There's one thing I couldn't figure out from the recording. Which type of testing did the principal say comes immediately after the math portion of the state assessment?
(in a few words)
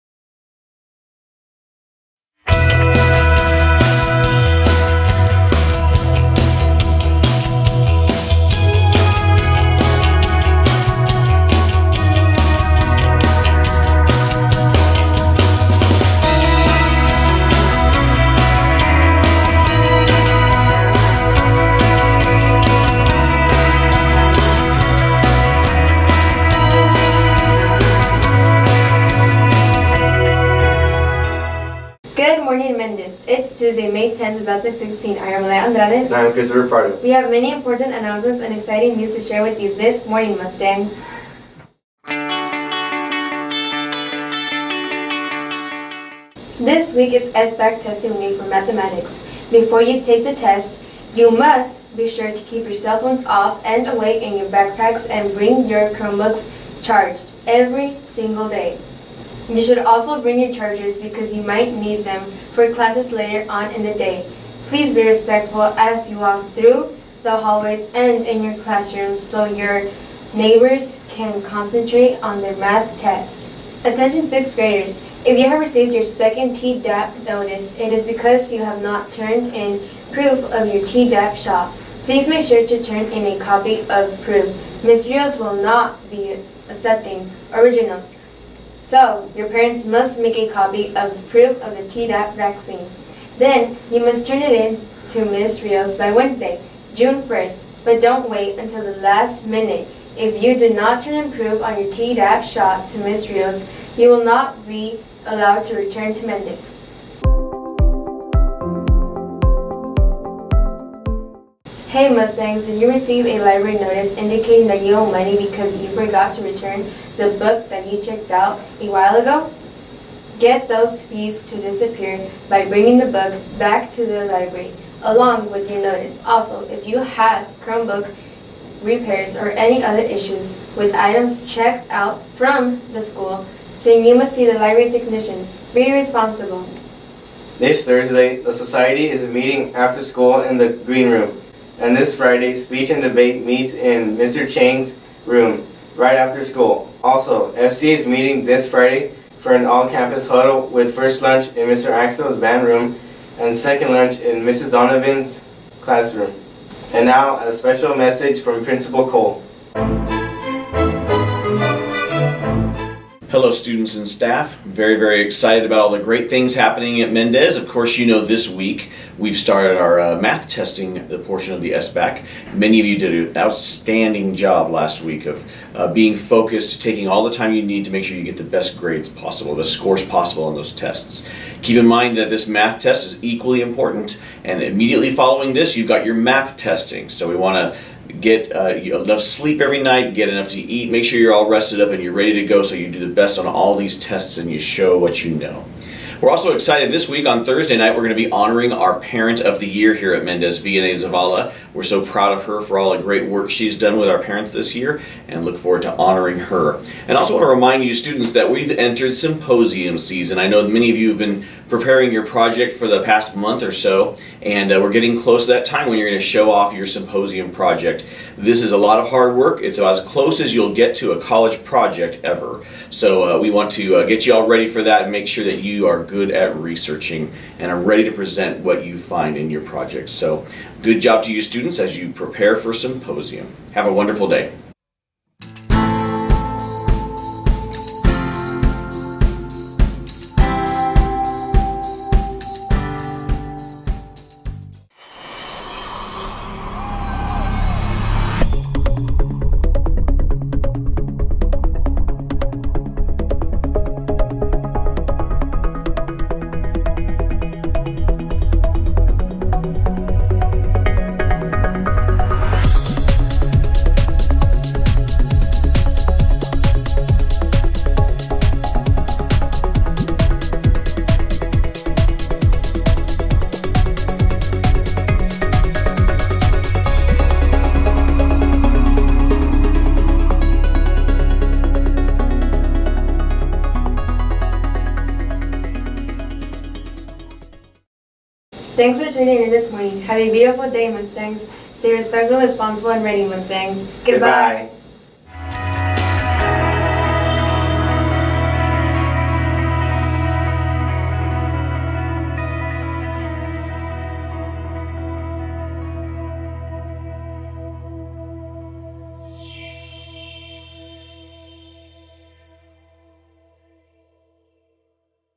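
MAP testing.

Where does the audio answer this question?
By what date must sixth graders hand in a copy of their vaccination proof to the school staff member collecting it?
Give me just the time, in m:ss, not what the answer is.
1:36.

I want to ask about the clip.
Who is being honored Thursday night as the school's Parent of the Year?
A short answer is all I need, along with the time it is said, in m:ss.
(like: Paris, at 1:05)
VNA Zavala, at 3:20.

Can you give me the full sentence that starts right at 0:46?
This week is SBAC testing week for mathematics.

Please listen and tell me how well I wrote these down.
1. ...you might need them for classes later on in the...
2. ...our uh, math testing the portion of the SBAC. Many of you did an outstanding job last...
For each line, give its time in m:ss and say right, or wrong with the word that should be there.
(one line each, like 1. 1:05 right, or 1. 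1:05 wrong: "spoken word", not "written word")
1. 1:01 right
2. 2:49 right.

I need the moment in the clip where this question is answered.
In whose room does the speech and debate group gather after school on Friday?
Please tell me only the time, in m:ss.
2:24.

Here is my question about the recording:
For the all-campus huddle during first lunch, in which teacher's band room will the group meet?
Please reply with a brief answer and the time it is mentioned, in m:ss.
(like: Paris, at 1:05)
Mr. Axel's, at 2:31.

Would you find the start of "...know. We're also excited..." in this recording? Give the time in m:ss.
3:15.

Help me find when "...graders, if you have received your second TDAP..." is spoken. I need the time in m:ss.
1:14.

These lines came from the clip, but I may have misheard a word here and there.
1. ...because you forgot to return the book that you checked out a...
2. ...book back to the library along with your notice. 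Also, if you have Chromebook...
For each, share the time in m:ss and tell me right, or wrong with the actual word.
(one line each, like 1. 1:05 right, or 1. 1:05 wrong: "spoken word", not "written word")
1. 1:55 right
2. 2:03 right.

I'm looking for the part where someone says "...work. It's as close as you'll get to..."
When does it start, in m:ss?
3:39.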